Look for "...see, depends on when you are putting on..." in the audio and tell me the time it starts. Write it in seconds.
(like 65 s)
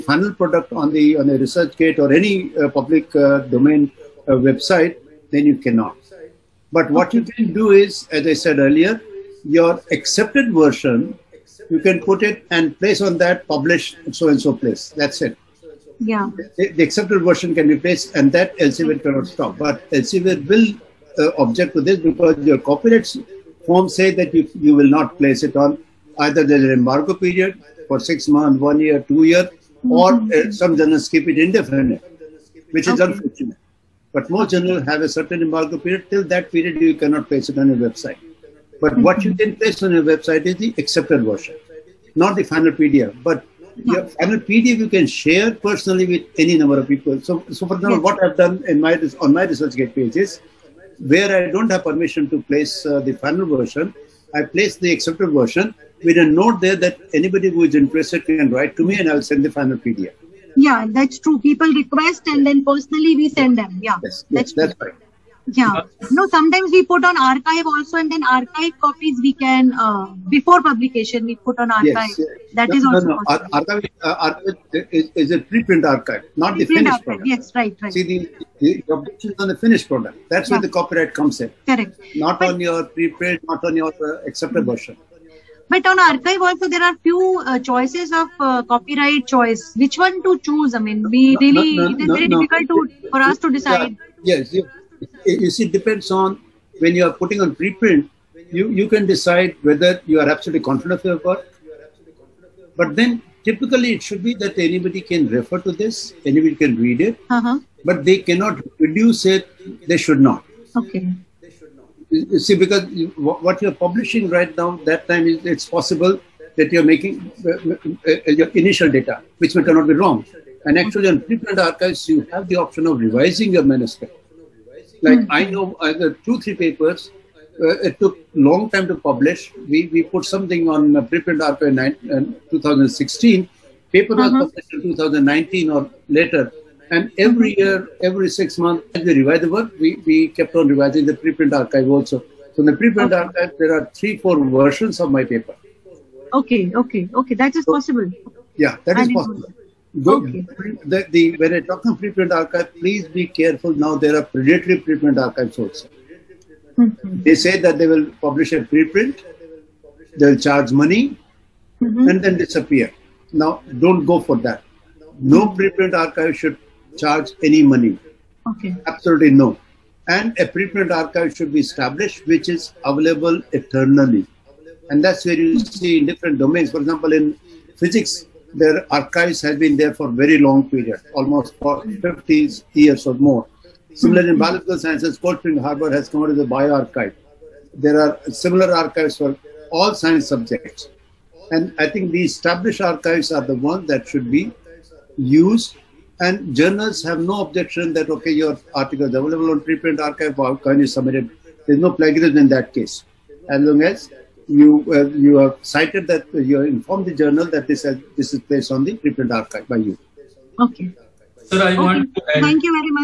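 95 s.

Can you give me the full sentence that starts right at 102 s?
But then typically it should be that anybody can refer to this, anybody can read it, uh-huh.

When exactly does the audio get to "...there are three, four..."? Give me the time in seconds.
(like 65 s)
143 s.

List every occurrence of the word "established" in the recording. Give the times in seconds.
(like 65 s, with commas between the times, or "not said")
171 s, 192 s.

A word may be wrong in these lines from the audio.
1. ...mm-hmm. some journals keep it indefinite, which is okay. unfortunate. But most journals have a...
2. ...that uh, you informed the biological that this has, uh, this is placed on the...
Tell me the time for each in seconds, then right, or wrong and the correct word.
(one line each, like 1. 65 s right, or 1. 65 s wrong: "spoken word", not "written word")
1. 30 s right
2. 206 s wrong: "journal", not "biological".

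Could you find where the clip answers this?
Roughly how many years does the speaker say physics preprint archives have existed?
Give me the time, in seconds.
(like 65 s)
181 s.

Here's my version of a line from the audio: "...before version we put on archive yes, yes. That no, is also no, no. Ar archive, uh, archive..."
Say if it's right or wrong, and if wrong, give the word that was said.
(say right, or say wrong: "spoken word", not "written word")
wrong: "publication", not "version".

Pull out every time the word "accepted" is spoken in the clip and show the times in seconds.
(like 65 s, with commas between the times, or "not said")
9 s, 16 s, 40 s, 54 s, 84 s.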